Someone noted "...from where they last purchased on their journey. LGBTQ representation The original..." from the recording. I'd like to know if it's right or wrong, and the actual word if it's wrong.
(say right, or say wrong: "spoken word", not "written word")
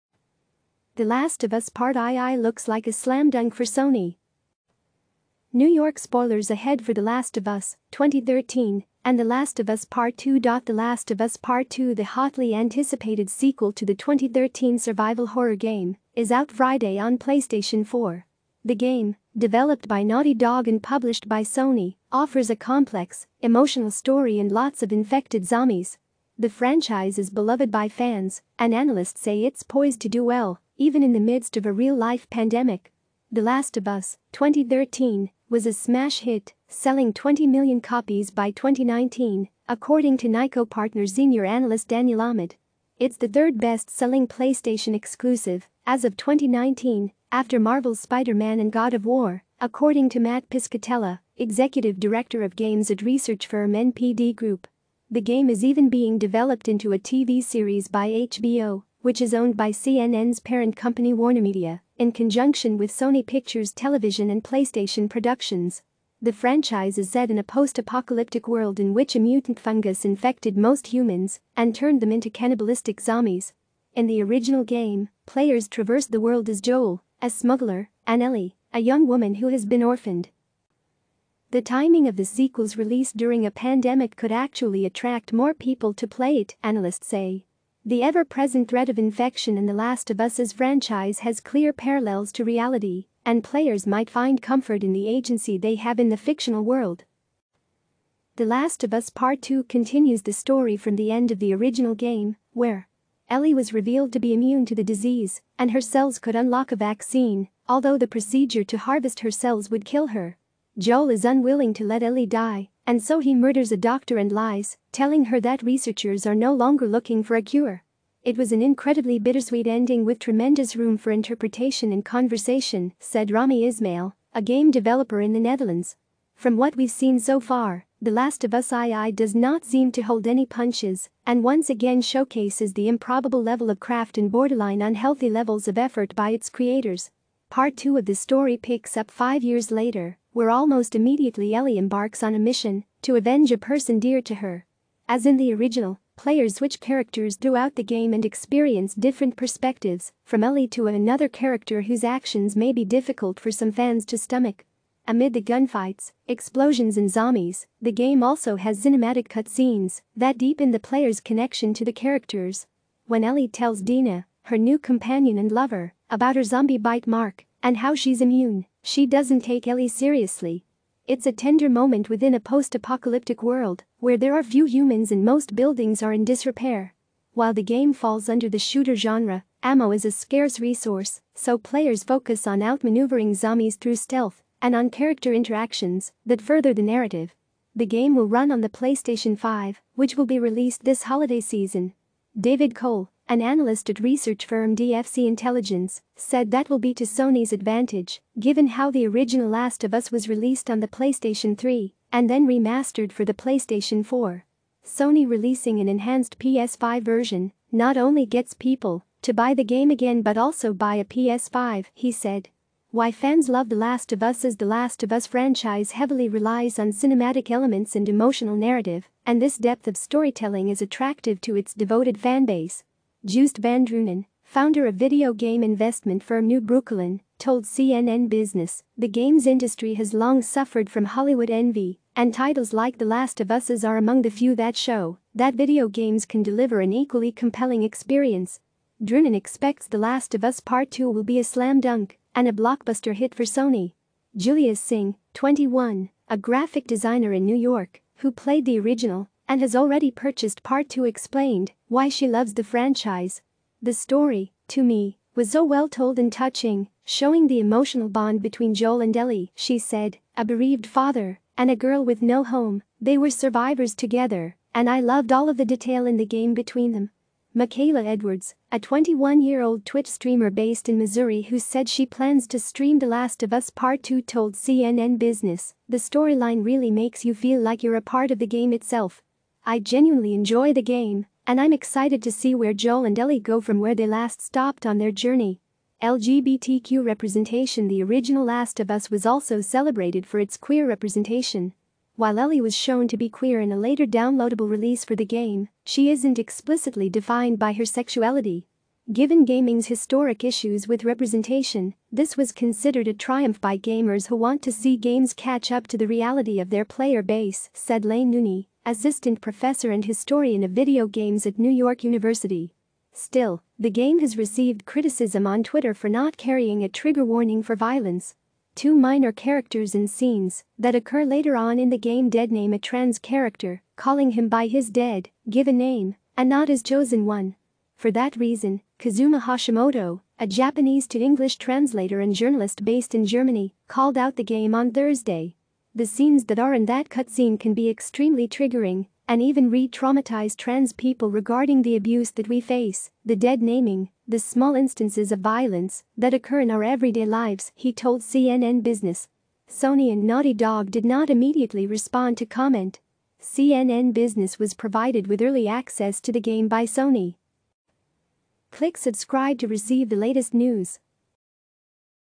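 wrong: "stopped", not "purchased".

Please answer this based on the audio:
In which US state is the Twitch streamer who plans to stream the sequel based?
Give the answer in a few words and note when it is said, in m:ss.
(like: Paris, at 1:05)
Missouri, at 4:30.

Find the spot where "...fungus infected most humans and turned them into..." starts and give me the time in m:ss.
1:09.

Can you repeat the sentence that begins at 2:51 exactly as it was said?
It's a tender moment within a post-apocalyptic world where there are few humans and most buildings are in disrepair.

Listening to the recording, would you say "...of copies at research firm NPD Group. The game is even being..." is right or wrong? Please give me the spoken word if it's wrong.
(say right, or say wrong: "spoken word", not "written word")
wrong: "games", not "copies".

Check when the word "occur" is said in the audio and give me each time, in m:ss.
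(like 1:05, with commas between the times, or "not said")
5:20, 5:46.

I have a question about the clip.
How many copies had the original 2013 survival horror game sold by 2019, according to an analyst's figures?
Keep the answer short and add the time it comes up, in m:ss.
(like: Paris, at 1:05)
20 million, at 0:37.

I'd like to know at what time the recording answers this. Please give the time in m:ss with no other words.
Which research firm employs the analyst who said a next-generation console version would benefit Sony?
3:14.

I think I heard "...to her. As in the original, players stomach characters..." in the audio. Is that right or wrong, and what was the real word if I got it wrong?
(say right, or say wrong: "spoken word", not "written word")
wrong: "switch", not "stomach".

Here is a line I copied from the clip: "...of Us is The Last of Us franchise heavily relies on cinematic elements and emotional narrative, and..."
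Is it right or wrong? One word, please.
right.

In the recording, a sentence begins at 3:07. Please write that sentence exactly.
The game will run on the PlayStation 5, which will be released this holiday season.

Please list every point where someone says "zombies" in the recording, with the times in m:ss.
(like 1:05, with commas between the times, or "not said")
0:25, 1:13, 2:37, 2:46, 3:03.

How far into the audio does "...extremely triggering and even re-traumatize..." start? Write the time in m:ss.
5:37.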